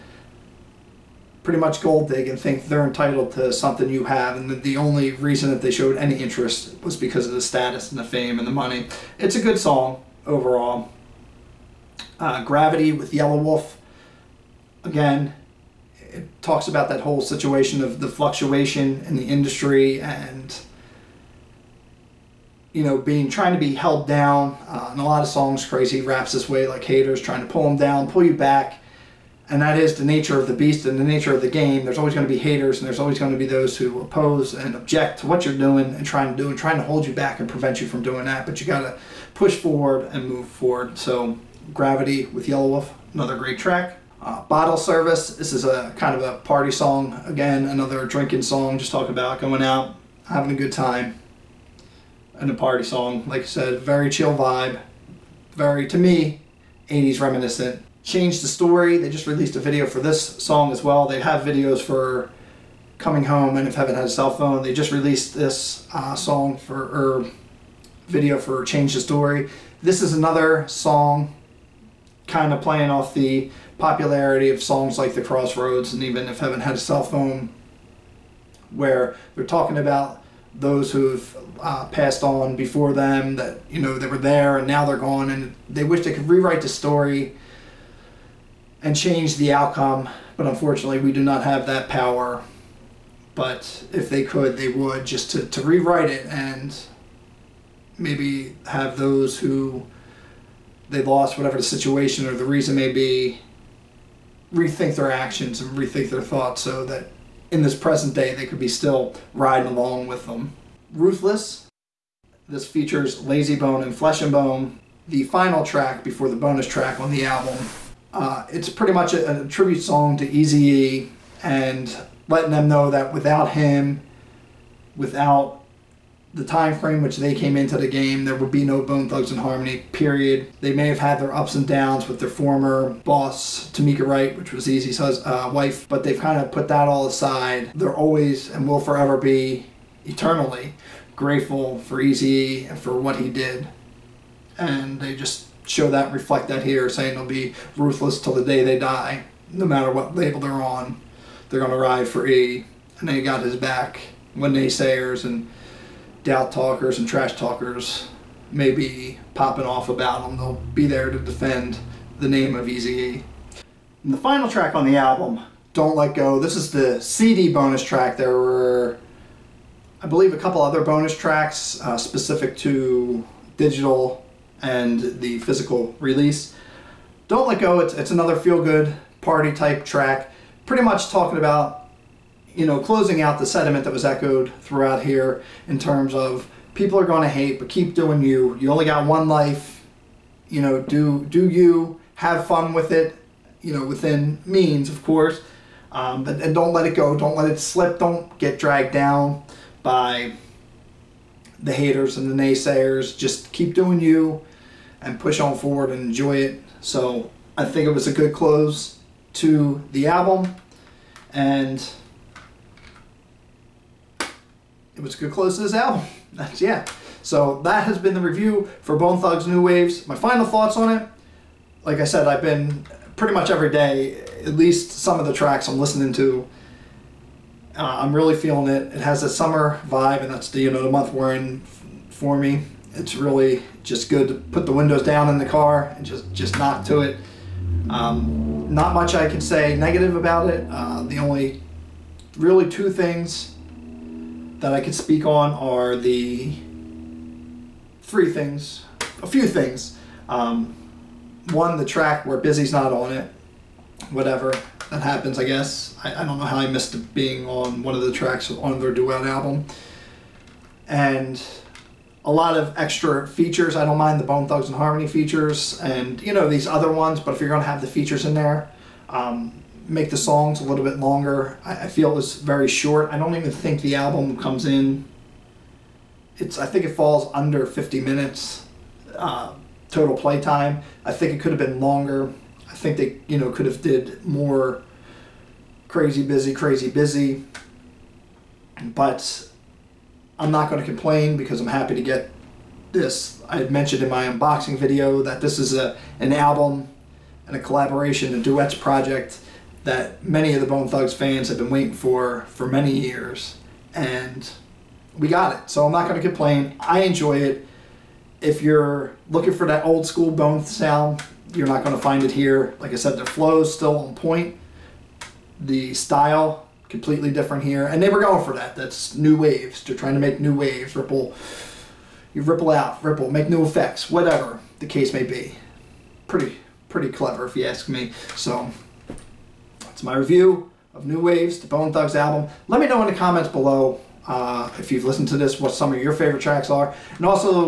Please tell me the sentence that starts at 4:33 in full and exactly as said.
I don't even think the album comes in.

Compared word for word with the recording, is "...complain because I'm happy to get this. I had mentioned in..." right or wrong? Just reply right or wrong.
right.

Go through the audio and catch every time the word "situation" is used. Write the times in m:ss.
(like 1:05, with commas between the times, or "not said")
0:17, 1:41.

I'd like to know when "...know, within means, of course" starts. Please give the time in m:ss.
3:13.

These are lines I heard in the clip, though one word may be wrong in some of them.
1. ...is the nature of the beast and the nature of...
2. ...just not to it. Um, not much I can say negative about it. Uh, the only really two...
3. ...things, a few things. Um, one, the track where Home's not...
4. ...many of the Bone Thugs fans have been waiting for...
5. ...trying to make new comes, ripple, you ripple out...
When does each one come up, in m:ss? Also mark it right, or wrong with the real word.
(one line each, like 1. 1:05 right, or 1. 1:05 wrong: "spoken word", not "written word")
1. 0:29 right
2. 3:56 right
3. 4:08 wrong: "Bizzy", not "Home"
4. 5:00 right
5. 5:19 wrong: "waves", not "comes".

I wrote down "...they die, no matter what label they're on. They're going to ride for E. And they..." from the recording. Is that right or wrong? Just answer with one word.
right.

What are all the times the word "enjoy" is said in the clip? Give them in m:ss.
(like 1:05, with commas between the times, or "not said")
3:26, 5:07.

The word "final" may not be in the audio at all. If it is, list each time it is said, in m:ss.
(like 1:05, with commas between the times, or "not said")
1:55, 2:44, 3:40.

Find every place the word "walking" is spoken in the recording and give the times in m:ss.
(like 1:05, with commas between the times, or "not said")
not said.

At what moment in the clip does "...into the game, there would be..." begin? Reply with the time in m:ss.
2:07.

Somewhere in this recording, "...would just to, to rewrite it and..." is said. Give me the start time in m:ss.
1:34.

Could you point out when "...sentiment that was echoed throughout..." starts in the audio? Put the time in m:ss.
3:03.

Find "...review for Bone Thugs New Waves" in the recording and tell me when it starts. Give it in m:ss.
3:38.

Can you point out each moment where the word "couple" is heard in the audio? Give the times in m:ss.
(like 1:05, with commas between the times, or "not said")
2:50.